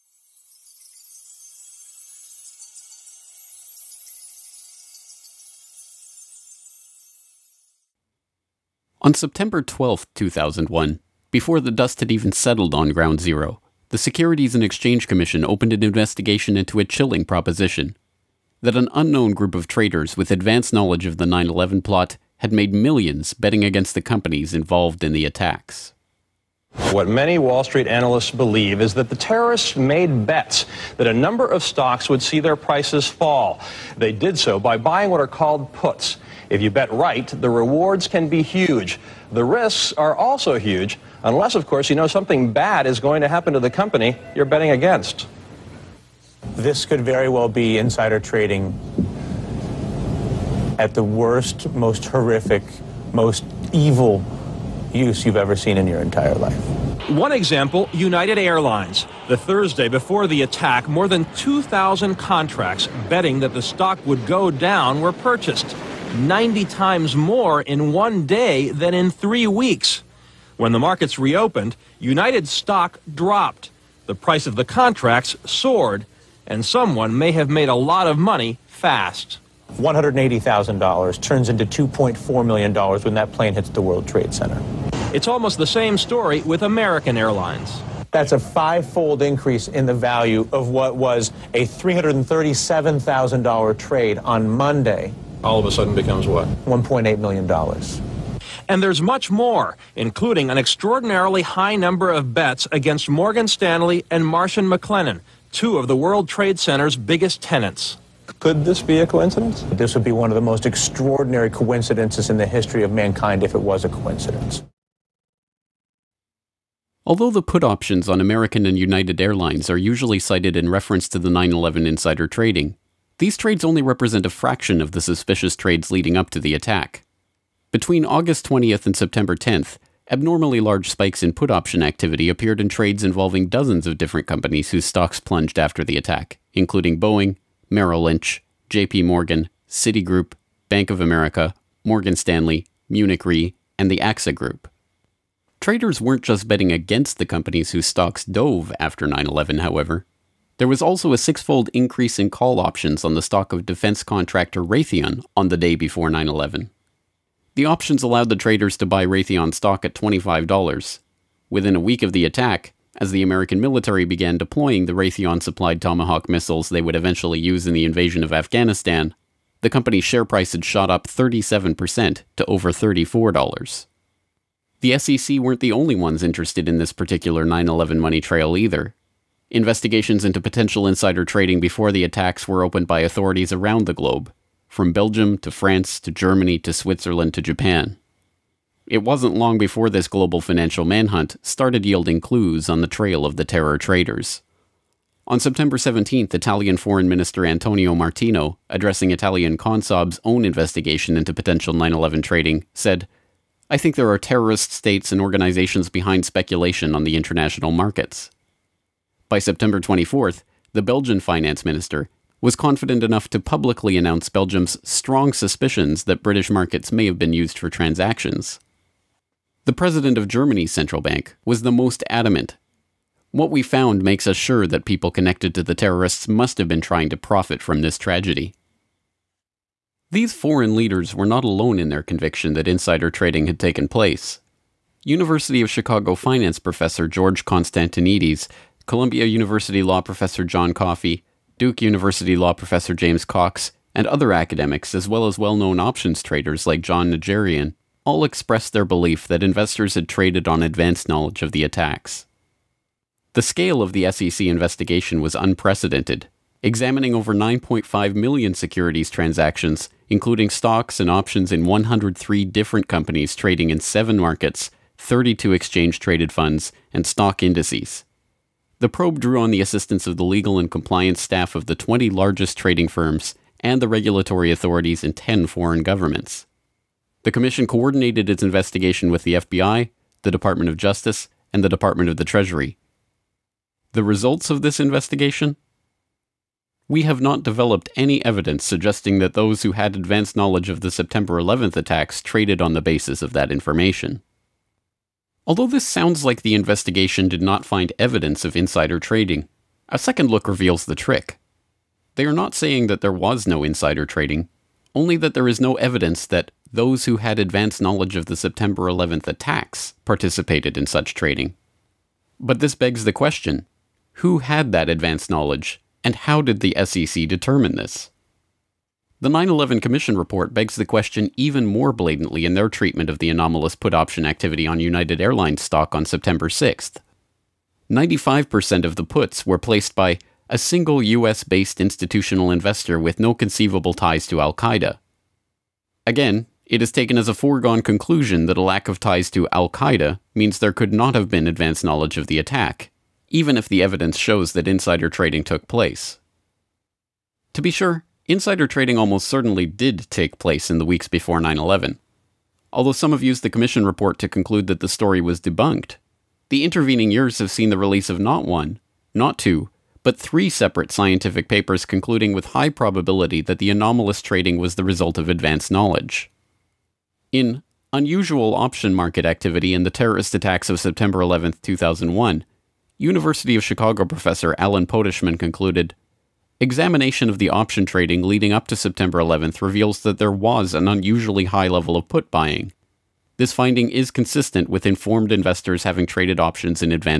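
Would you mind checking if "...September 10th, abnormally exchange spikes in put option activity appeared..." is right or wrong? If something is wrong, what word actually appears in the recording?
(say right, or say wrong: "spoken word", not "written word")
wrong: "large", not "exchange".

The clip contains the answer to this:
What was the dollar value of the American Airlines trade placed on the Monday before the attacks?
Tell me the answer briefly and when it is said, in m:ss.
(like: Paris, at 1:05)
$337,000, at 1:31.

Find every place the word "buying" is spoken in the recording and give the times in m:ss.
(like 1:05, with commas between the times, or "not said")
0:34, 6:22.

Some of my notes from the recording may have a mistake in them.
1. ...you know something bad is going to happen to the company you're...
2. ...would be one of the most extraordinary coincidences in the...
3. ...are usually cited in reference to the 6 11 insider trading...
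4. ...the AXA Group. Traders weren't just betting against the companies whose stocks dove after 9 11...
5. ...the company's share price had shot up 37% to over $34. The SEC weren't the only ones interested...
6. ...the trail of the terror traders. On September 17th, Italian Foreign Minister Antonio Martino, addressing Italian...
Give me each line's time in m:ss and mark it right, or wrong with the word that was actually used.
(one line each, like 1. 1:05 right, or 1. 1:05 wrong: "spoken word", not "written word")
1. 0:41 right
2. 1:49 right
3. 1:59 wrong: "9", not "6"
4. 2:23 right
5. 2:49 right
6. 3:12 right.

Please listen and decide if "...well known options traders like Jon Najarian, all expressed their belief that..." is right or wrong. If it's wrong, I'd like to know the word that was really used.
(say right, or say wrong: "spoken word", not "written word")
right.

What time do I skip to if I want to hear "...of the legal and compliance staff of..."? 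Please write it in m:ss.
4:30.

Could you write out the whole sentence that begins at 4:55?
Although this sounds like the investigation did not find evidence of insider trading, a second look reveals the trick.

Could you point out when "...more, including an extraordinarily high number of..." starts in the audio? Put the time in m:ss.
1:39.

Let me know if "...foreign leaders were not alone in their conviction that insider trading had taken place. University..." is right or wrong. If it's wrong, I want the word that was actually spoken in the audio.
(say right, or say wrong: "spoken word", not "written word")
right.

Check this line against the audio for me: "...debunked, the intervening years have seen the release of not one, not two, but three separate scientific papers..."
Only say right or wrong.
right.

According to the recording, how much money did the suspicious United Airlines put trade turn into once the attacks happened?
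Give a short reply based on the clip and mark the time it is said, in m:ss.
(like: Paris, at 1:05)
$2.4 million, at 1:21.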